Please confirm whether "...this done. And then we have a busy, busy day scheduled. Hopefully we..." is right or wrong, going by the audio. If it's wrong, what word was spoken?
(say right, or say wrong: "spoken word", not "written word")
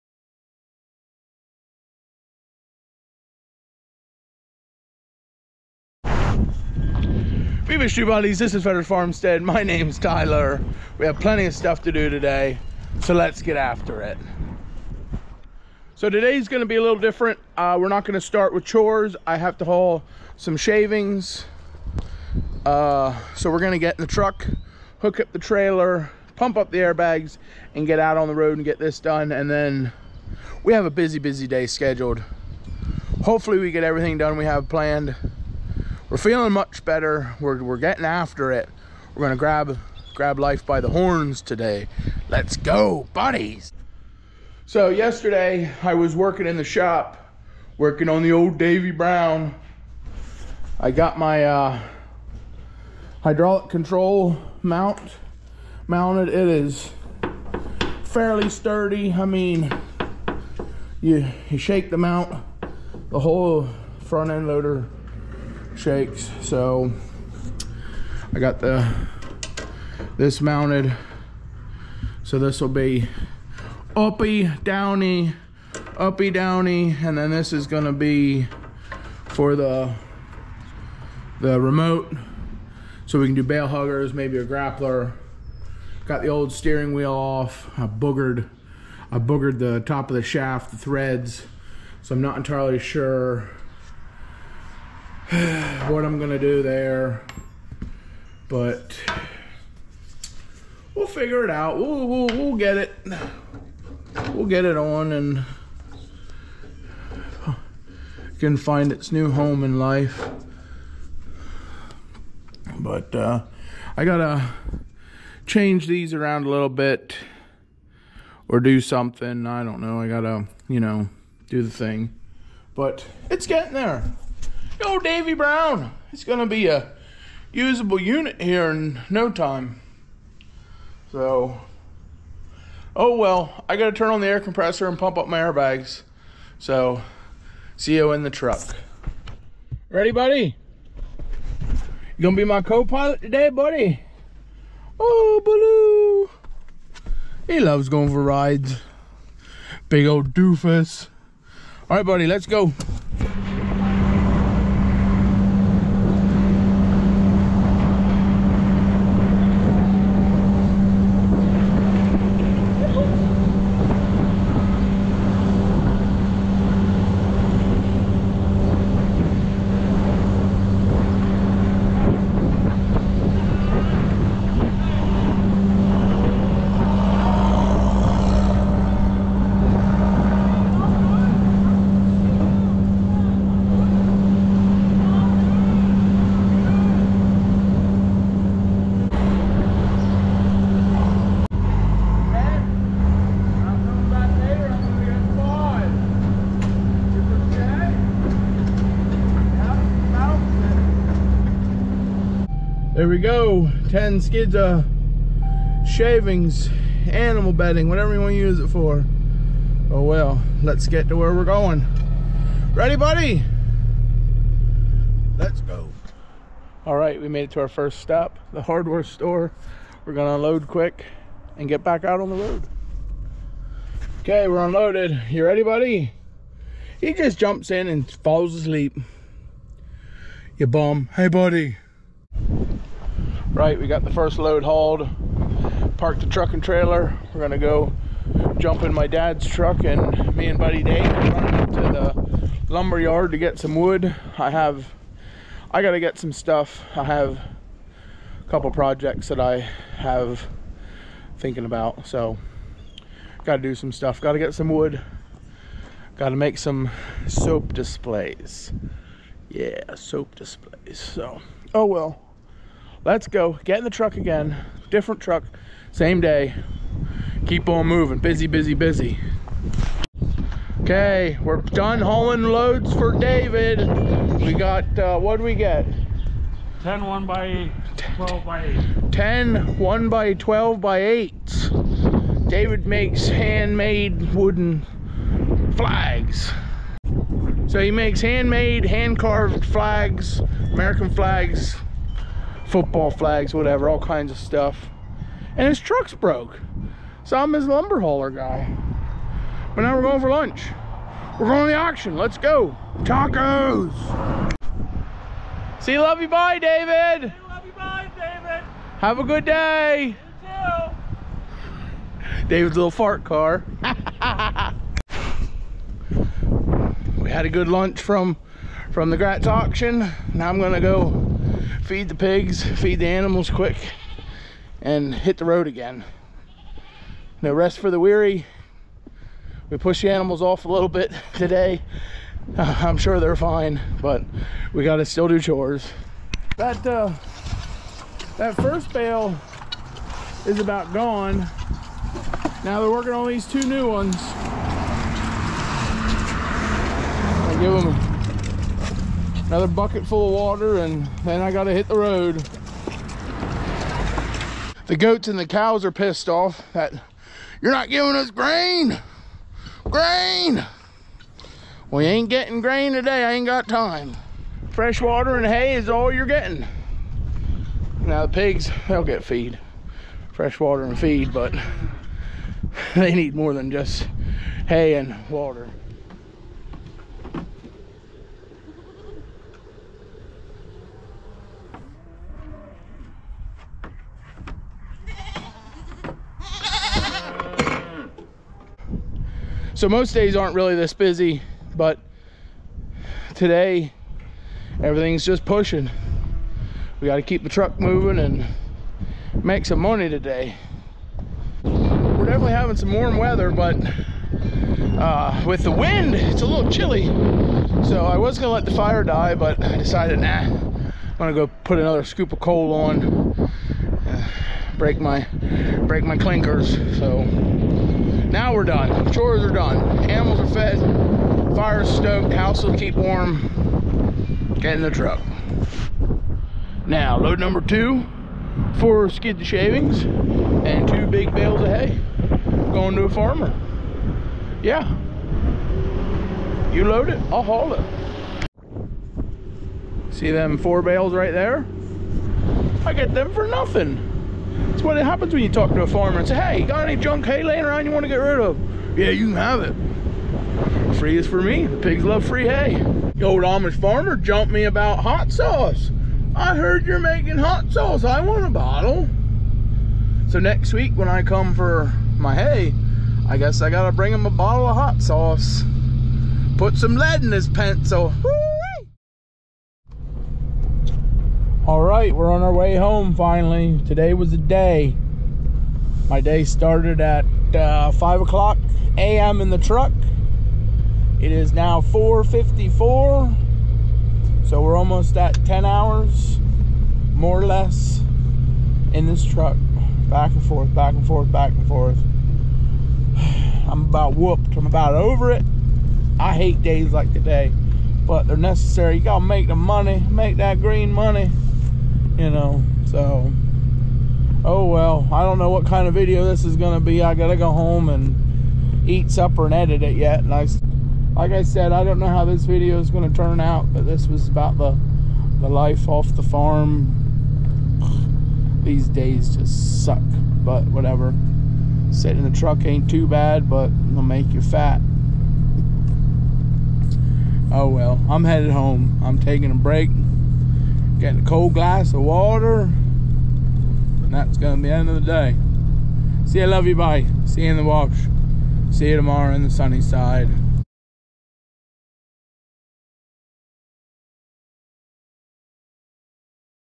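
right.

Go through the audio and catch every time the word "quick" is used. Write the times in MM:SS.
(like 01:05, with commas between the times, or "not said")
03:40, 05:23.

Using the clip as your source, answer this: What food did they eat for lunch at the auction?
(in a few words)
Tacos.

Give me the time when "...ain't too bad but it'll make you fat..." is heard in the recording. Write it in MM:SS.
08:42.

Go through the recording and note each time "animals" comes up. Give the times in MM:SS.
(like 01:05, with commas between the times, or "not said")
03:27, 05:23, 05:30, 07:00.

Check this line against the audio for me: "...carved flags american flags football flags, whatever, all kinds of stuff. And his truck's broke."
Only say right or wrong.
right.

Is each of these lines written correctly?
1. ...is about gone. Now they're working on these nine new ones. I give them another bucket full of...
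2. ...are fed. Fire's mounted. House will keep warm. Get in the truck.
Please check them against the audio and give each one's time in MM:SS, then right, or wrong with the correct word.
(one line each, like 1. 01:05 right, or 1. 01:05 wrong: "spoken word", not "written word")
1. 05:40 wrong: "two", not "nine"
2. 07:00 wrong: "stoked", not "mounted".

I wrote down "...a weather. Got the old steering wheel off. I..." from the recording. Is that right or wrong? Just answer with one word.
wrong.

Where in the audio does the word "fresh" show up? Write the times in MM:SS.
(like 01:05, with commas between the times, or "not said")
06:04, 06:10.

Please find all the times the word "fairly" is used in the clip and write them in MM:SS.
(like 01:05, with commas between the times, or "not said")
00:58.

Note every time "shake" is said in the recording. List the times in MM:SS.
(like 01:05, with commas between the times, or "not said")
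01:01, 01:05.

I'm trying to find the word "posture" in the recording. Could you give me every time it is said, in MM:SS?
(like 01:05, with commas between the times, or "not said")
not said.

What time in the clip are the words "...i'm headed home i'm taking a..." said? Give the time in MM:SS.
08:48.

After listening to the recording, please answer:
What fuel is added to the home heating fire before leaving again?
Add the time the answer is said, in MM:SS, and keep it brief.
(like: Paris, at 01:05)
coal, at 06:52.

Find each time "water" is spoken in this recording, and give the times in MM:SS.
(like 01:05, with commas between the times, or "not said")
05:50, 06:05, 06:10, 06:15, 08:52.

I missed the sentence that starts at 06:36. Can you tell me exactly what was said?
We got to keep the truck moving and make some money today.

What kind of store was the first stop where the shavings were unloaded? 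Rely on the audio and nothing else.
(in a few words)
hardware store.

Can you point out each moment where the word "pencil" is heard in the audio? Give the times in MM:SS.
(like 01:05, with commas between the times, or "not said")
07:47.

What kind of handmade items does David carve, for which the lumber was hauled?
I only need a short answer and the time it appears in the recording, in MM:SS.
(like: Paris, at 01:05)
wooden flags, at 04:44.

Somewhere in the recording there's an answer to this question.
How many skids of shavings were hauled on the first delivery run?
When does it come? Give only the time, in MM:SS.
03:23.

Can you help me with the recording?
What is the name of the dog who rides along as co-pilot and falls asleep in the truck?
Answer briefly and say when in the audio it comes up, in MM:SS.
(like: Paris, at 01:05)
Baloo, at 02:26.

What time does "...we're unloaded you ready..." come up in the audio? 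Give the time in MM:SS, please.
03:44.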